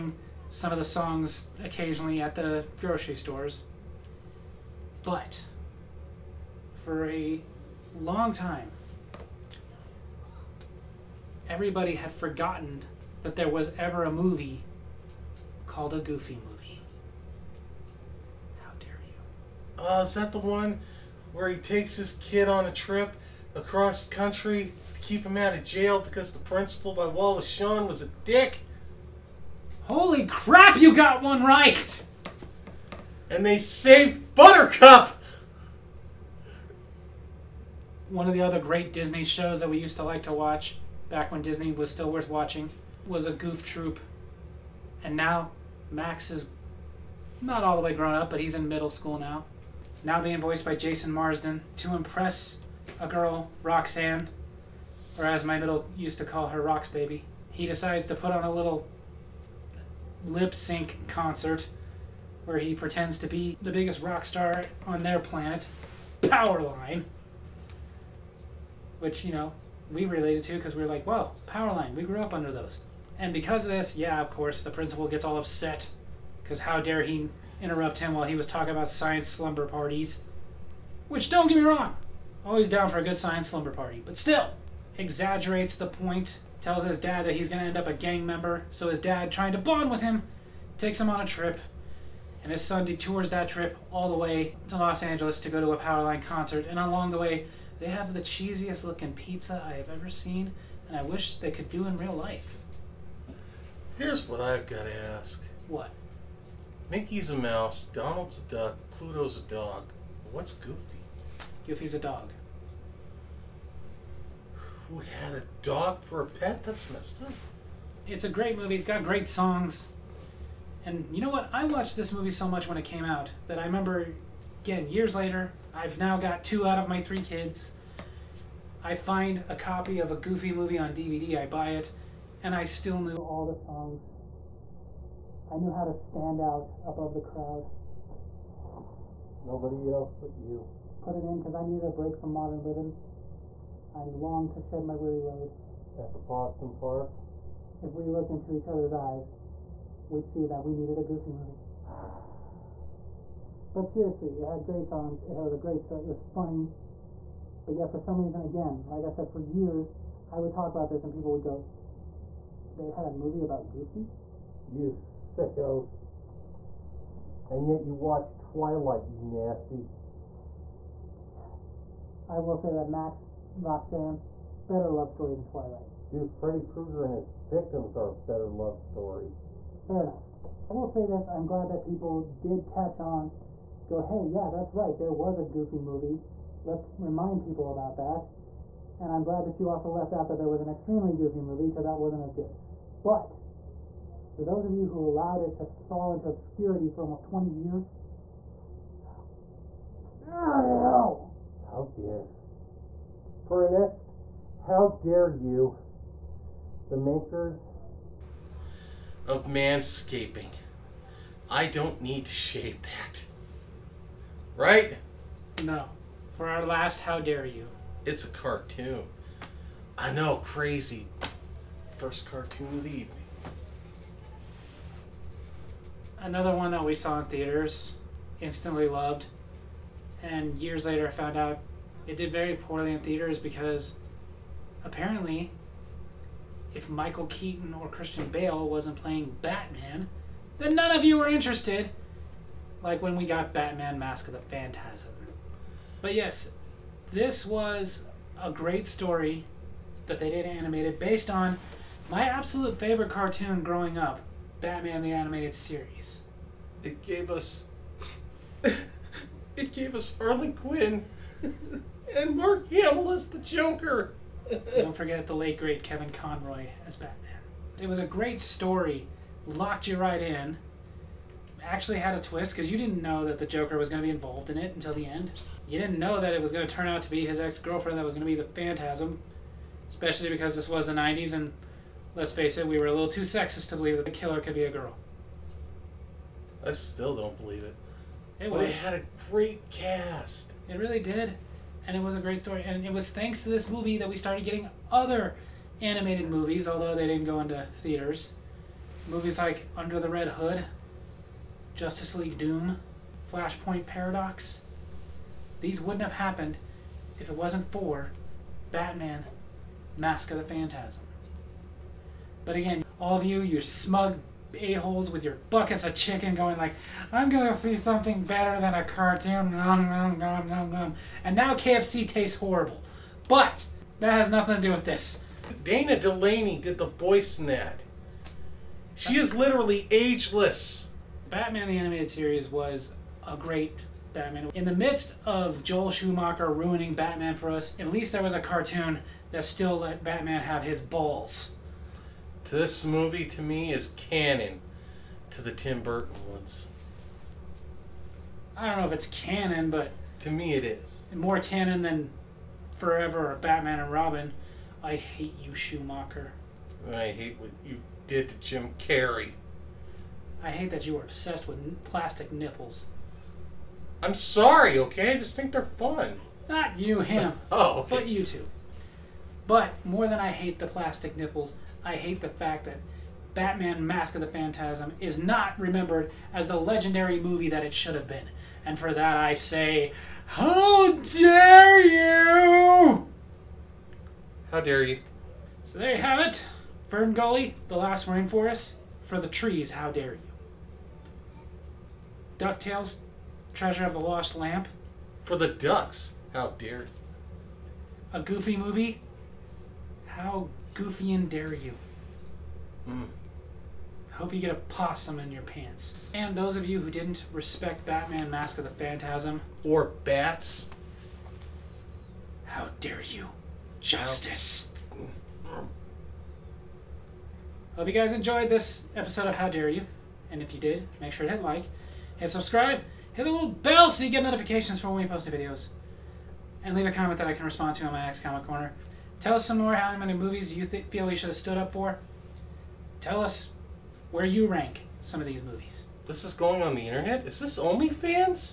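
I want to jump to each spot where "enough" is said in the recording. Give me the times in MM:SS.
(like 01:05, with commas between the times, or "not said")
03:00.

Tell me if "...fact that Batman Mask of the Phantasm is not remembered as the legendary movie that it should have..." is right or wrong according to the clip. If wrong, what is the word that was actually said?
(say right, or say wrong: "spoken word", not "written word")
right.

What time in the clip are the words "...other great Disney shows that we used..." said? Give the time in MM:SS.
00:38.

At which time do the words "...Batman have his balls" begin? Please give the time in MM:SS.
05:40.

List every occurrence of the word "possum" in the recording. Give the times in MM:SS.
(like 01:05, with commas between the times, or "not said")
02:26, 06:44.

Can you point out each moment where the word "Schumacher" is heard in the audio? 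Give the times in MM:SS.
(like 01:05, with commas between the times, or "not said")
05:35, 05:55.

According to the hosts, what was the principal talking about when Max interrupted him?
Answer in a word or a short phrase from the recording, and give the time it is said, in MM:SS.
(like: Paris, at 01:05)
science slumber parties, at 01:18.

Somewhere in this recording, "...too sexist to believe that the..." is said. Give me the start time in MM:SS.
04:43.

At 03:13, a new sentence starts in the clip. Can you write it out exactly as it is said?
But for those of you who allowed it to fall into obscurity for almost 20 years, how dare you?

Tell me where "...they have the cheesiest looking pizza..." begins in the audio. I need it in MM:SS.
01:37.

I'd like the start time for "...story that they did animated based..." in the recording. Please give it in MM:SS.
04:08.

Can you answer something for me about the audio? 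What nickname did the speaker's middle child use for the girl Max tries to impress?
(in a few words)
Rox Baby.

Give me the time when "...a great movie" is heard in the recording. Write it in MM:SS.
01:58.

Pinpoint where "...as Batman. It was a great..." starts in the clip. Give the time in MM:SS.
04:26.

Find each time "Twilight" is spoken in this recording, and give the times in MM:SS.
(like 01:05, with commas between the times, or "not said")
02:48, 02:55.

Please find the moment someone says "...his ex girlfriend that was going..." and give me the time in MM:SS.
04:37.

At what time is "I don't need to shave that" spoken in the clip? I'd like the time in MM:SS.
03:31.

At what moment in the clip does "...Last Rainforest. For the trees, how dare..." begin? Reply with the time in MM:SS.
06:27.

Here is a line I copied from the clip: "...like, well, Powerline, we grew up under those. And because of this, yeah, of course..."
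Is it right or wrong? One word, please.
right.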